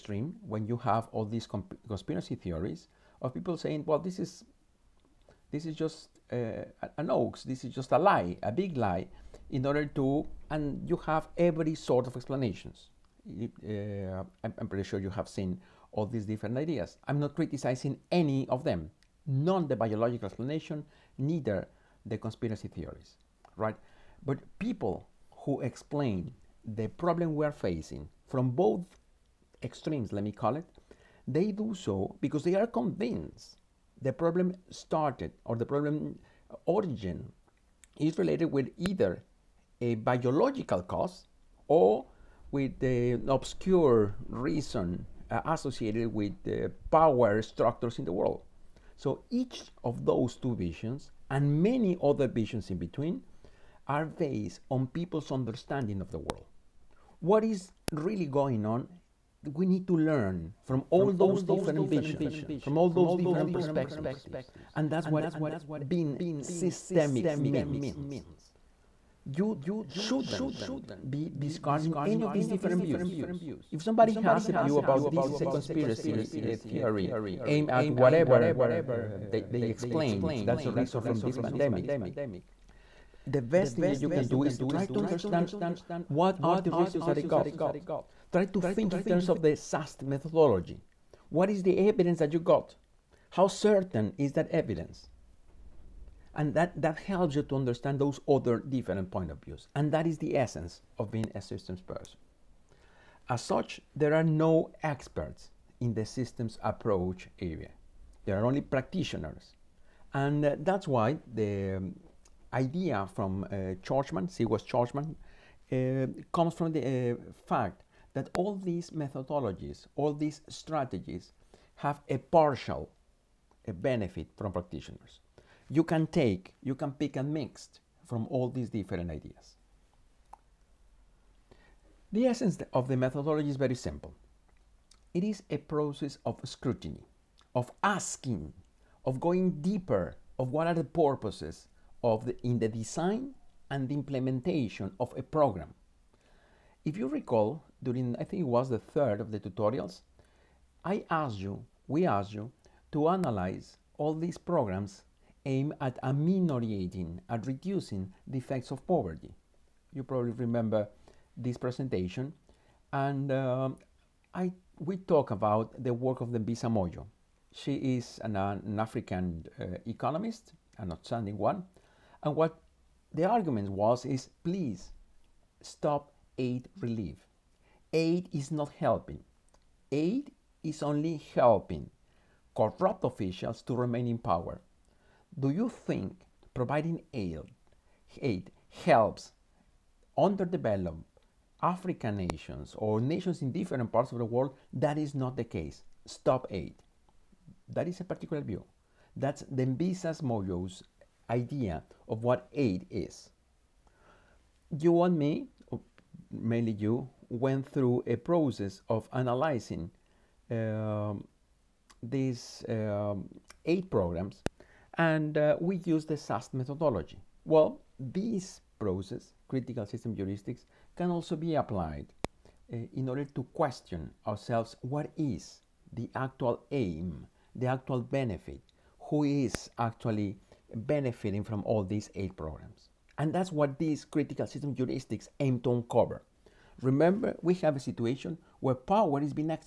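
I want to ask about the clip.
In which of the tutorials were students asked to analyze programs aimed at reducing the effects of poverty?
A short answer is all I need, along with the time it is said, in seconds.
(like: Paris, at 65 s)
the third, at 148 s.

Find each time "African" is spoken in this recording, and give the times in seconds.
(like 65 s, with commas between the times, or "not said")
168 s, 191 s.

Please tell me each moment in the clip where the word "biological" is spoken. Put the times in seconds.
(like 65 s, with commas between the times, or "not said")
19 s, 39 s.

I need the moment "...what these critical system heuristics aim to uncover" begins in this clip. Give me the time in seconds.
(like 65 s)
233 s.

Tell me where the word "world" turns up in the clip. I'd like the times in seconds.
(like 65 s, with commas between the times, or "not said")
48 s, 56 s, 194 s.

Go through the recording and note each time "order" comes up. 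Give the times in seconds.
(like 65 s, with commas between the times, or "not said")
9 s, 223 s.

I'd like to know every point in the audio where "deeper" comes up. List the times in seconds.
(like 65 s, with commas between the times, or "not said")
139 s.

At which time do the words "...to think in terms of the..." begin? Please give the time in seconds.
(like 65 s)
88 s.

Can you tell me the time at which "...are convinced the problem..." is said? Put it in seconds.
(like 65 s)
32 s.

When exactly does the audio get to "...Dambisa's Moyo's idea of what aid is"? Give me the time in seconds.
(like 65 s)
199 s.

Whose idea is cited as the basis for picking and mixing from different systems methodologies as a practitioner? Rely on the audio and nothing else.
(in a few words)
C. West Churchman.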